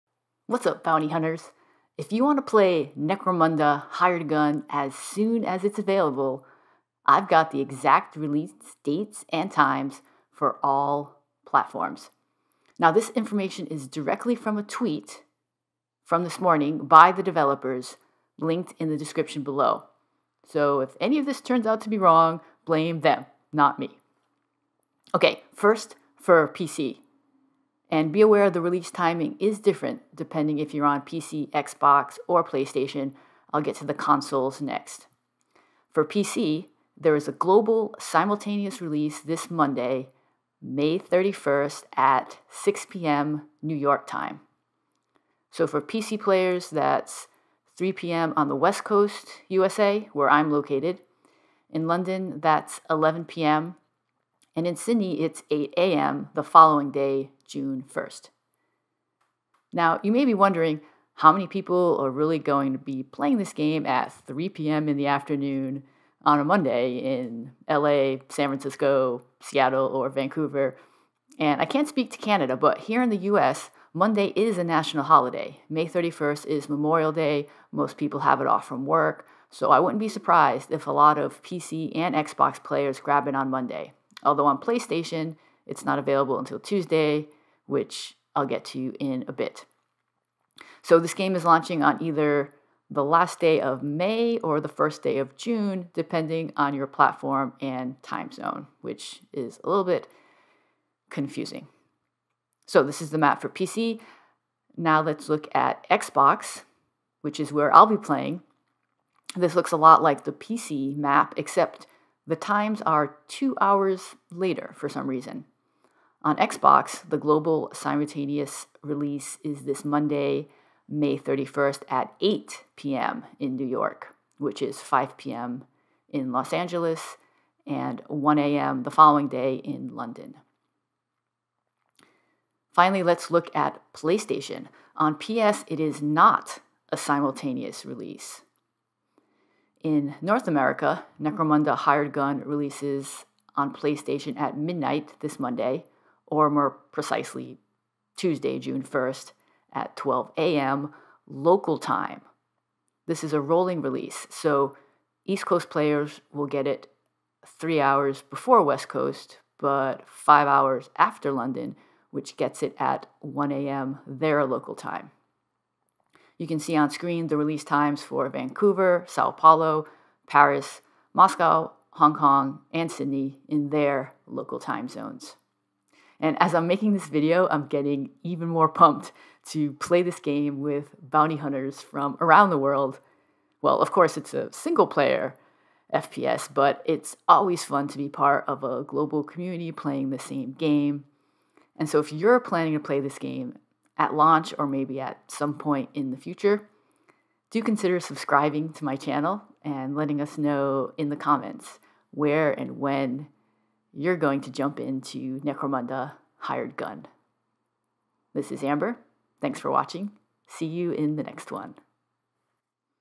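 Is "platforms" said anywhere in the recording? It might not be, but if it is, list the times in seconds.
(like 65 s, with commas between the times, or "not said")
11 s, 96 s.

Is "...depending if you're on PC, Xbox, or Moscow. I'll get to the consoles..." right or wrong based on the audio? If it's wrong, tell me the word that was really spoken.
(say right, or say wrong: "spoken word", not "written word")
wrong: "PlayStation", not "Moscow".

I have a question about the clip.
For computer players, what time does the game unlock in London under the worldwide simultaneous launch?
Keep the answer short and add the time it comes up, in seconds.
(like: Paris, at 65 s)
11 p.m., at 52 s.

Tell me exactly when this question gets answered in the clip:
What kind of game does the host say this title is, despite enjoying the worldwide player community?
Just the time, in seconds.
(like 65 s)
184 s.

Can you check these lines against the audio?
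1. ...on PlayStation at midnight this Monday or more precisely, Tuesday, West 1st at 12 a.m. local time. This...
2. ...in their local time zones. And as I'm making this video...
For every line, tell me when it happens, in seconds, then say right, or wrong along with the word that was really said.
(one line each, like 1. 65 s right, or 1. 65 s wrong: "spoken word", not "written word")
1. 143 s wrong: "June", not "West"
2. 173 s right.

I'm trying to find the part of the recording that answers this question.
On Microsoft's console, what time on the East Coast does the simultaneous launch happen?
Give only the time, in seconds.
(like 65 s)
122 s.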